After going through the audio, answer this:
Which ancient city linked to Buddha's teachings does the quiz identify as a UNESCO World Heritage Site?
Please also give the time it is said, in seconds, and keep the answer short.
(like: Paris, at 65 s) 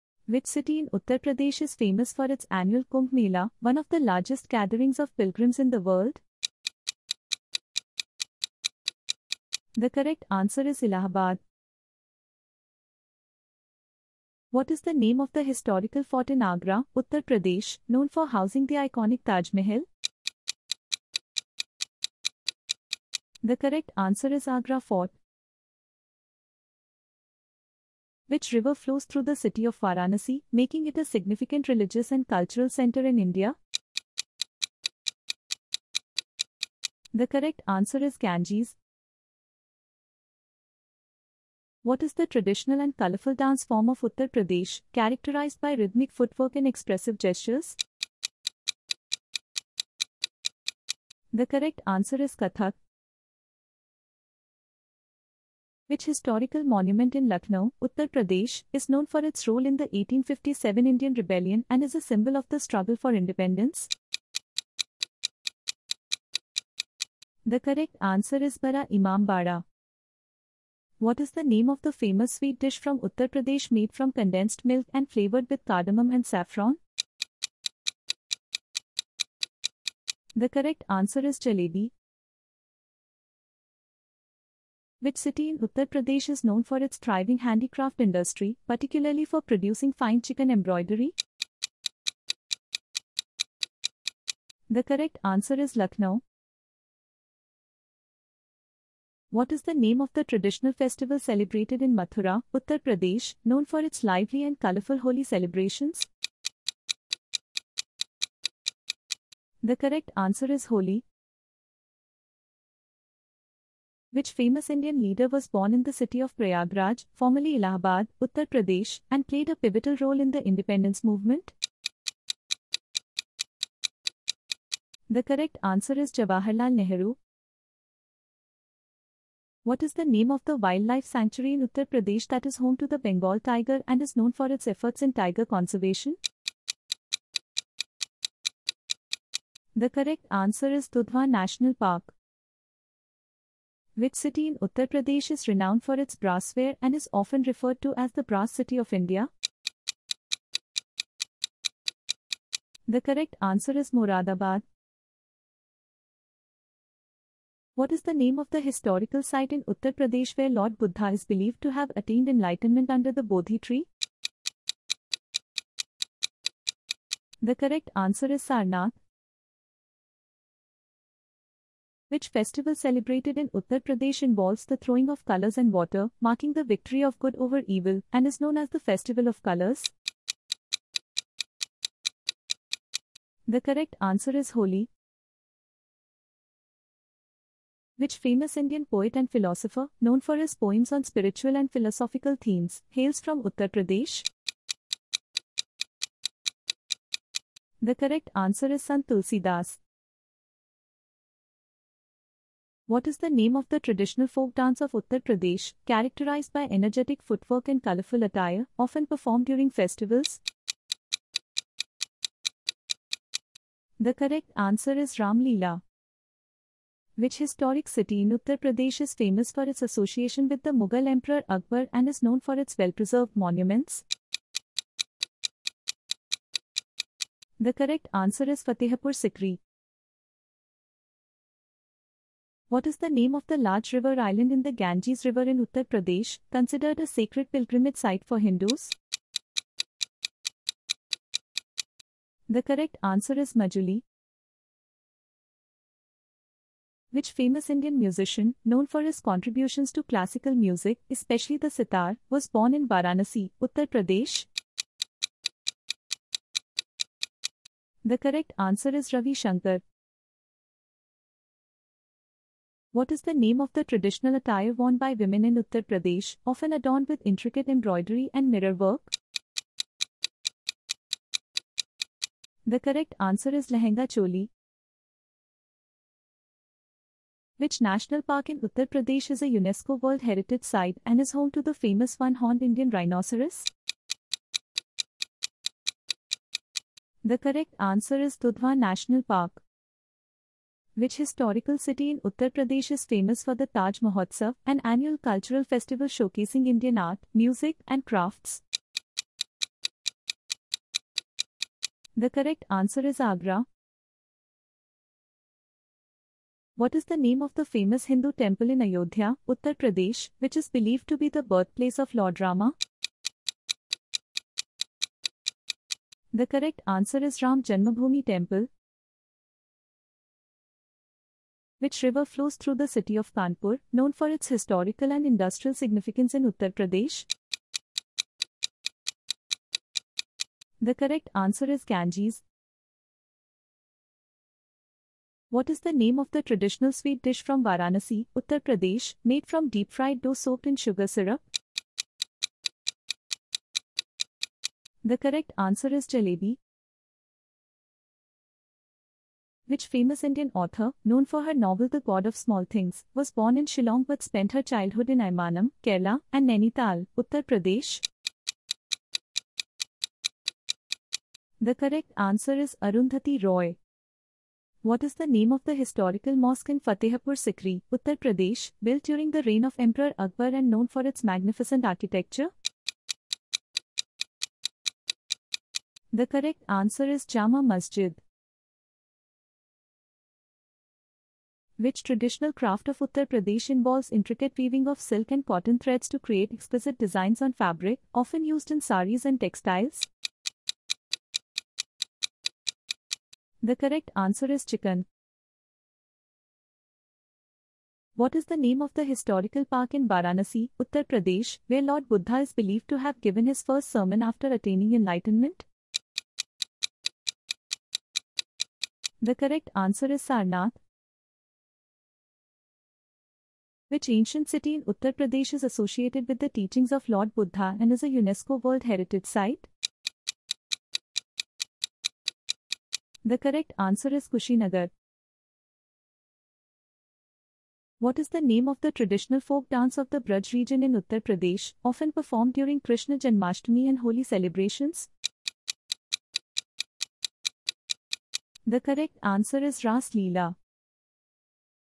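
Kushinagar, at 424 s.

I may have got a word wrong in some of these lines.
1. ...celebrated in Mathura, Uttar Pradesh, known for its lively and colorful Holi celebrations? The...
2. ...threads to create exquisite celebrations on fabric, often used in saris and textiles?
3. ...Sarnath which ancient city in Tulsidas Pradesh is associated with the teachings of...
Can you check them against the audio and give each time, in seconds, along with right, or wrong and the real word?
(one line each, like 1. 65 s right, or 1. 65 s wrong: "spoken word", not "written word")
1. 101 s right
2. 385 s wrong: "designs", not "celebrations"
3. 410 s wrong: "Uttar", not "Tulsidas".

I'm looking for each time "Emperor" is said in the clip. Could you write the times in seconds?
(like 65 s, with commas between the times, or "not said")
221 s, 369 s.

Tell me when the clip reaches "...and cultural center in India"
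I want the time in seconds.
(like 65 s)
32 s.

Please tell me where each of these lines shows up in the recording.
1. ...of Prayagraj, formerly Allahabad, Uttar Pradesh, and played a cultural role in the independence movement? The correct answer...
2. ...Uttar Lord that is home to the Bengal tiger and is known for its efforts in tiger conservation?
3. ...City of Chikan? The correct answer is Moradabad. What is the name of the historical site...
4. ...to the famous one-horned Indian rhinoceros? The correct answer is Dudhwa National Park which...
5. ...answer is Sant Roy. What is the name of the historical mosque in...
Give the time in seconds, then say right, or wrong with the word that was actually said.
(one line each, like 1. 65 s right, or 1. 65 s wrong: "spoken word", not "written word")
1. 116 s wrong: "pivotal", not "cultural"
2. 131 s wrong: "Pradesh", not "Lord"
3. 148 s wrong: "India", not "Chikan"
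4. 281 s right
5. 362 s wrong: "Arundhati", not "Sant".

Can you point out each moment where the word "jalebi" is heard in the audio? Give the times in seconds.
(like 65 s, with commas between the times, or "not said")
81 s, 346 s.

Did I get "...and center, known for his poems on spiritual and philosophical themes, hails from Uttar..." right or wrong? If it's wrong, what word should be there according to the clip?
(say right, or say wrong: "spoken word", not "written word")
wrong: "philosopher", not "center".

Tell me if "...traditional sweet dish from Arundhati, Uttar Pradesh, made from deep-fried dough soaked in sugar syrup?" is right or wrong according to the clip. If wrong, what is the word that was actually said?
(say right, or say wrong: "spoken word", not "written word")
wrong: "Varanasi", not "Arundhati".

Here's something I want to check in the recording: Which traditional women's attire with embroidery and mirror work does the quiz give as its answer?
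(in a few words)
Lehenga Choli.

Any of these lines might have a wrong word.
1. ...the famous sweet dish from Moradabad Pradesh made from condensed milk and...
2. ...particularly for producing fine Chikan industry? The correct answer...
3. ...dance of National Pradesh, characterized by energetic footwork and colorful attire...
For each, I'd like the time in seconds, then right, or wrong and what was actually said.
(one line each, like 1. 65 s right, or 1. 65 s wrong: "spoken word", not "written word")
1. 71 s wrong: "Uttar", not "Moradabad"
2. 88 s wrong: "embroidery", not "industry"
3. 204 s wrong: "Uttar", not "National".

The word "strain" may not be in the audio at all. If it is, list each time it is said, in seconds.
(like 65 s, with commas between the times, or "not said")
not said.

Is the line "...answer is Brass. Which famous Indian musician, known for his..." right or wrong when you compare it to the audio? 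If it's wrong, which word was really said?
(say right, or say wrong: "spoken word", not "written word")
wrong: "Majuli", not "Brass".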